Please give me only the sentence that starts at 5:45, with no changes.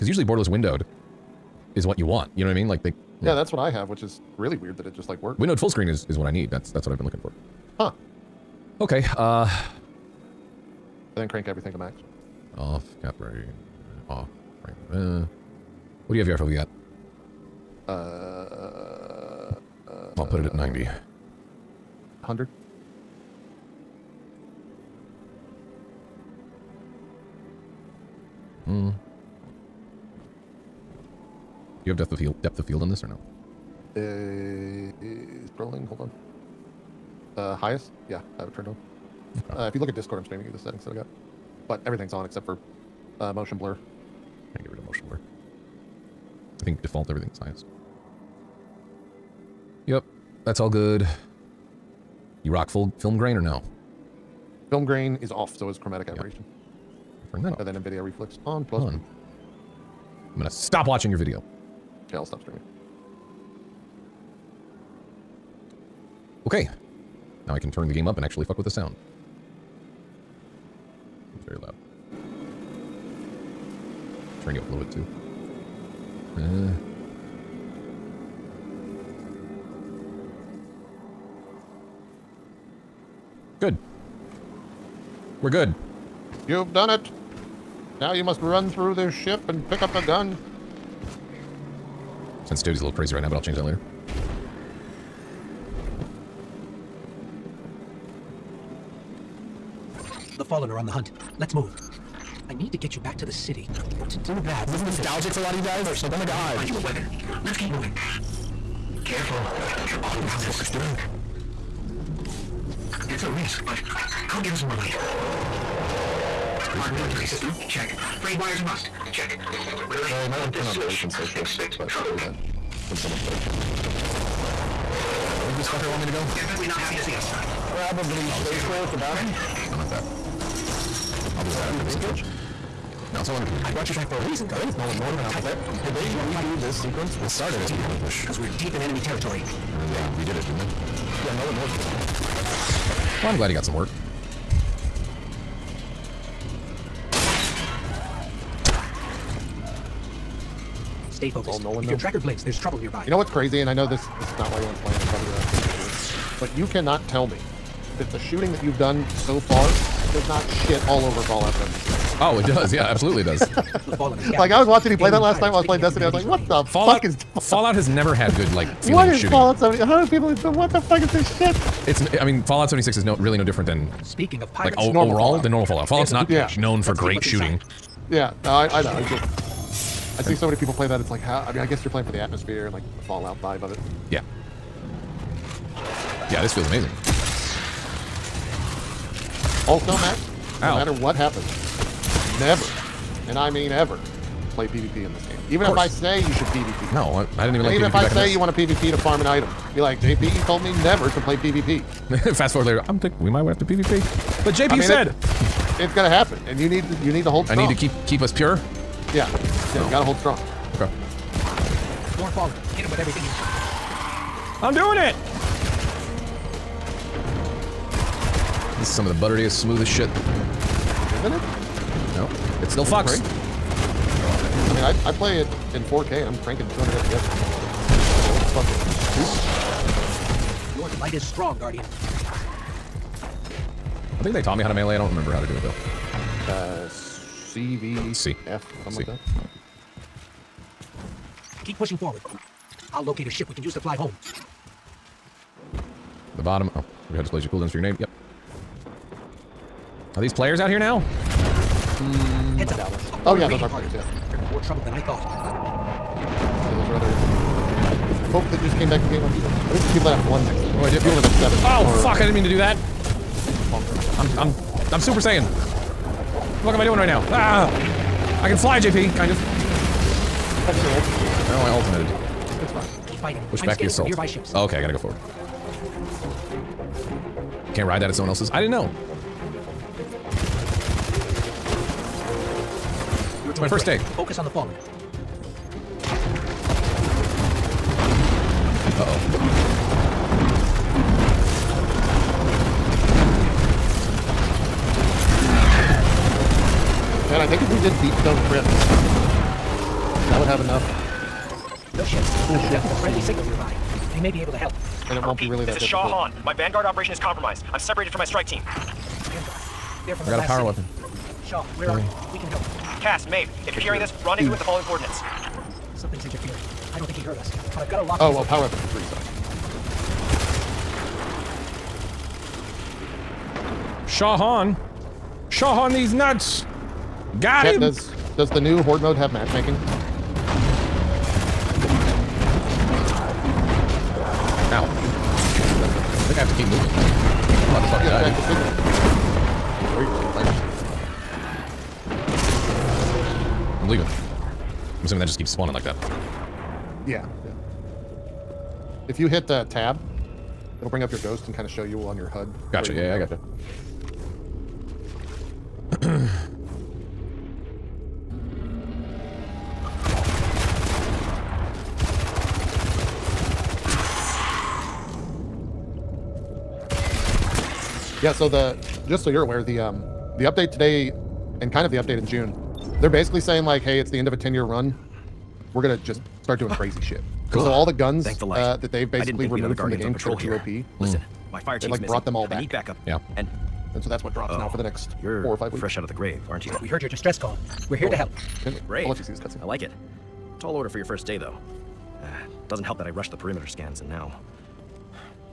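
assuming that just keeps spawning like that.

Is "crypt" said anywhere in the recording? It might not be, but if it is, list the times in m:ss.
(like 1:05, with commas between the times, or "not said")
4:58.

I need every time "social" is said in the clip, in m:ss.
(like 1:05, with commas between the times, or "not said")
2:01, 2:08.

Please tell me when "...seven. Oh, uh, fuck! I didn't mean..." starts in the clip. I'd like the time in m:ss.
4:21.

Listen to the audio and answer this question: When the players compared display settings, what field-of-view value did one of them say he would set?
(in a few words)
90.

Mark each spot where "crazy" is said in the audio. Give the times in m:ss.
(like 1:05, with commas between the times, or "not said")
1:32, 2:33, 6:16.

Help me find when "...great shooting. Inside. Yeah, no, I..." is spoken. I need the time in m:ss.
2:56.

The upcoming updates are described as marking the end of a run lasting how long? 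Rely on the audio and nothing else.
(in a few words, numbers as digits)
10 years.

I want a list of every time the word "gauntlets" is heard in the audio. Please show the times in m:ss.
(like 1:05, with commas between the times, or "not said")
not said.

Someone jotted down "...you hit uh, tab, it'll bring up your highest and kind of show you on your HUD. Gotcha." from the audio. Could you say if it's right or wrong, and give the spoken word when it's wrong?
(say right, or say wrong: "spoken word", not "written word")
wrong: "ghost", not "highest".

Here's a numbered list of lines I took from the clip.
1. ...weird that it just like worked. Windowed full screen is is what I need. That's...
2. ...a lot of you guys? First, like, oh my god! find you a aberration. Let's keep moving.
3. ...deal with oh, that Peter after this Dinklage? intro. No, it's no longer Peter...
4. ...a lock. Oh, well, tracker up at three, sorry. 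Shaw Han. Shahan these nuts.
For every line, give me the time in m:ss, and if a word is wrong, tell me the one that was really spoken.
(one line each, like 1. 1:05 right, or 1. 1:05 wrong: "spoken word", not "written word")
1. 0:04 right
2. 1:45 wrong: "weapon", not "aberration"
3. 2:11 right
4. 5:17 wrong: "power", not "tracker".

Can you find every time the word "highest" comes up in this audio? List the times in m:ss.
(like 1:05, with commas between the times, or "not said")
0:37, 0:47.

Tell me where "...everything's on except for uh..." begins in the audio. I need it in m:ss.
0:41.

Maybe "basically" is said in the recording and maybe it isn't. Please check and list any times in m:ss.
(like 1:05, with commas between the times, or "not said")
6:13, 6:19.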